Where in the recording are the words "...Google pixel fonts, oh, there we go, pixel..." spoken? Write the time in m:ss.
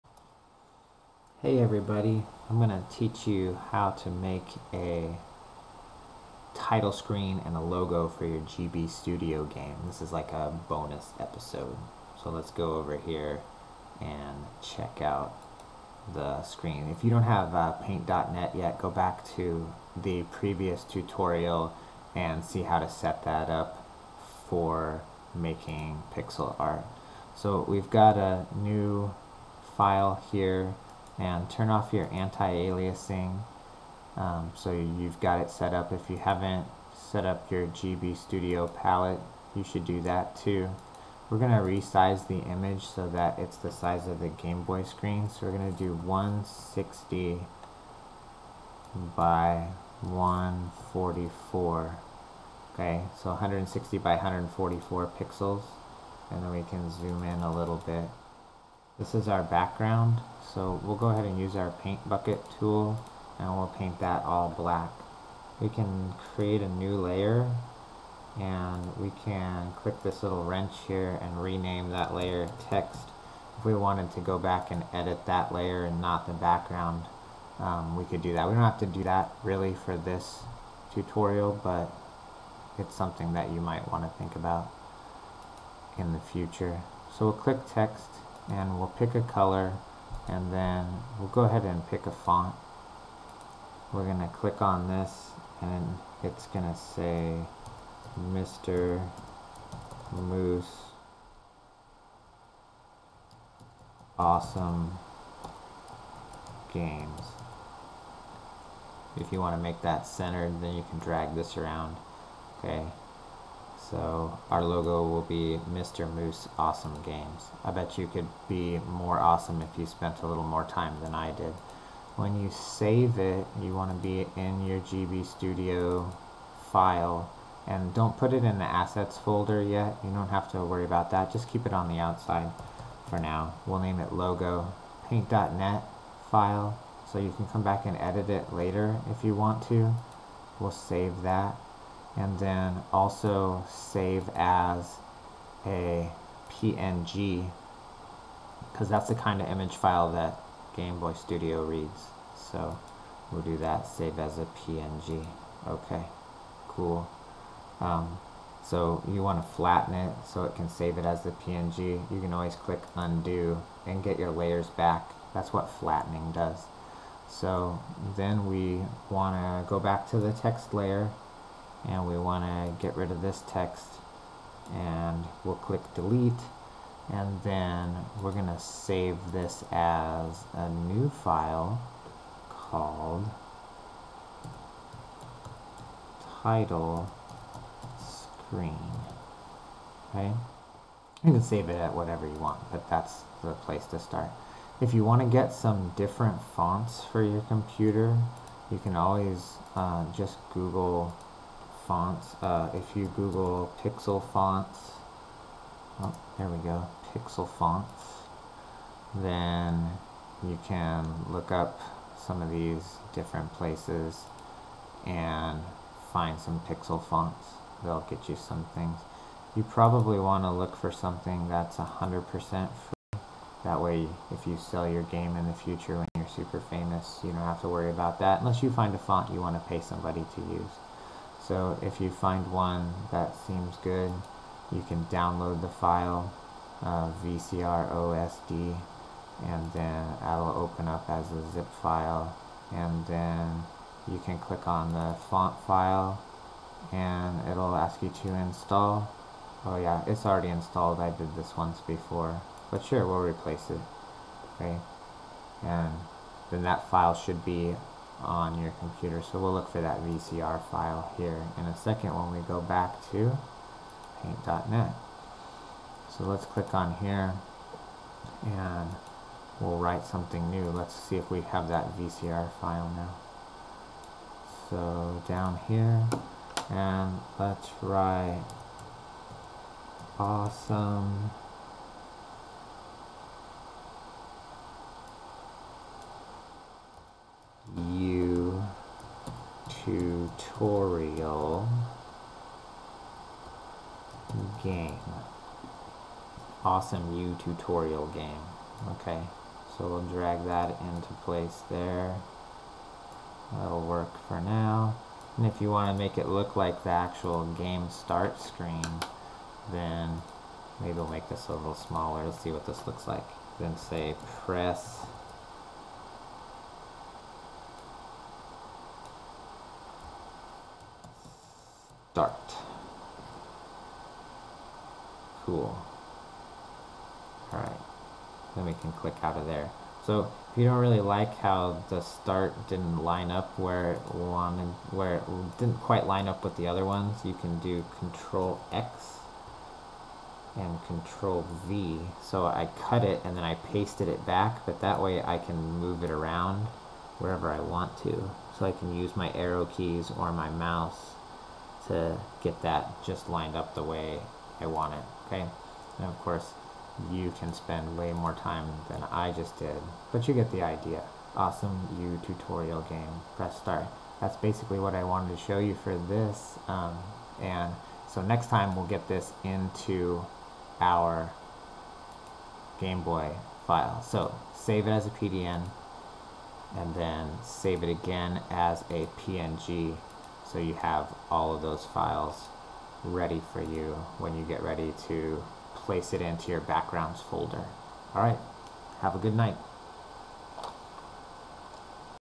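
3:23.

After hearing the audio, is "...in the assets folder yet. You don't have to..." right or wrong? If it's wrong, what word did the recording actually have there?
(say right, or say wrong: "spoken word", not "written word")
right.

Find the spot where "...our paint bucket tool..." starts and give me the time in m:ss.
1:01.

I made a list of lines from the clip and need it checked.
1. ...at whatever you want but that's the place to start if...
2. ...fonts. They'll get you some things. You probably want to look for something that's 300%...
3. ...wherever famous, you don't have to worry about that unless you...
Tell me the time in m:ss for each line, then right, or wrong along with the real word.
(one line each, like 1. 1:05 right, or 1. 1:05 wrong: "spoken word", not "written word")
1. 3:11 right
2. 3:37 wrong: "100", not "300"
3. 3:46 wrong: "super", not "wherever".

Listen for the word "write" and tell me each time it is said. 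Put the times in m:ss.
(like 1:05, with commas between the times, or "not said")
4:29, 4:37.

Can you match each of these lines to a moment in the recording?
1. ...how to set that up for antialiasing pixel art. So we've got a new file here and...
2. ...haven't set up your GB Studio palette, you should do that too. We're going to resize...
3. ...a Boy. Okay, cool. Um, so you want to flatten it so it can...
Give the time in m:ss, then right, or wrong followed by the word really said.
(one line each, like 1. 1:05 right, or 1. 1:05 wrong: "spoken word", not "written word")
1. 0:22 wrong: "making", not "antialiasing"
2. 0:36 right
3. 2:34 wrong: "PNG", not "Boy".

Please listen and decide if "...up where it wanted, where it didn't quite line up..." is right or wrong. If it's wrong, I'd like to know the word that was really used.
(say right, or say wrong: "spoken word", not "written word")
right.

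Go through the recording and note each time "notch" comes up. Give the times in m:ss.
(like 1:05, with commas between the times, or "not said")
not said.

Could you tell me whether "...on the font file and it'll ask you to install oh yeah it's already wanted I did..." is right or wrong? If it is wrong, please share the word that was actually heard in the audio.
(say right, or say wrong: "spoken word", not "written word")
wrong: "installed", not "wanted".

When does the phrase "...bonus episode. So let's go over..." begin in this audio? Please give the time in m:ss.
0:10.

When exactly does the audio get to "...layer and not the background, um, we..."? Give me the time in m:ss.
1:15.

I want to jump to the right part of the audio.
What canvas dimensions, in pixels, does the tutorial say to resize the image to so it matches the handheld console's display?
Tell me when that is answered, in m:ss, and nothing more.
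0:53.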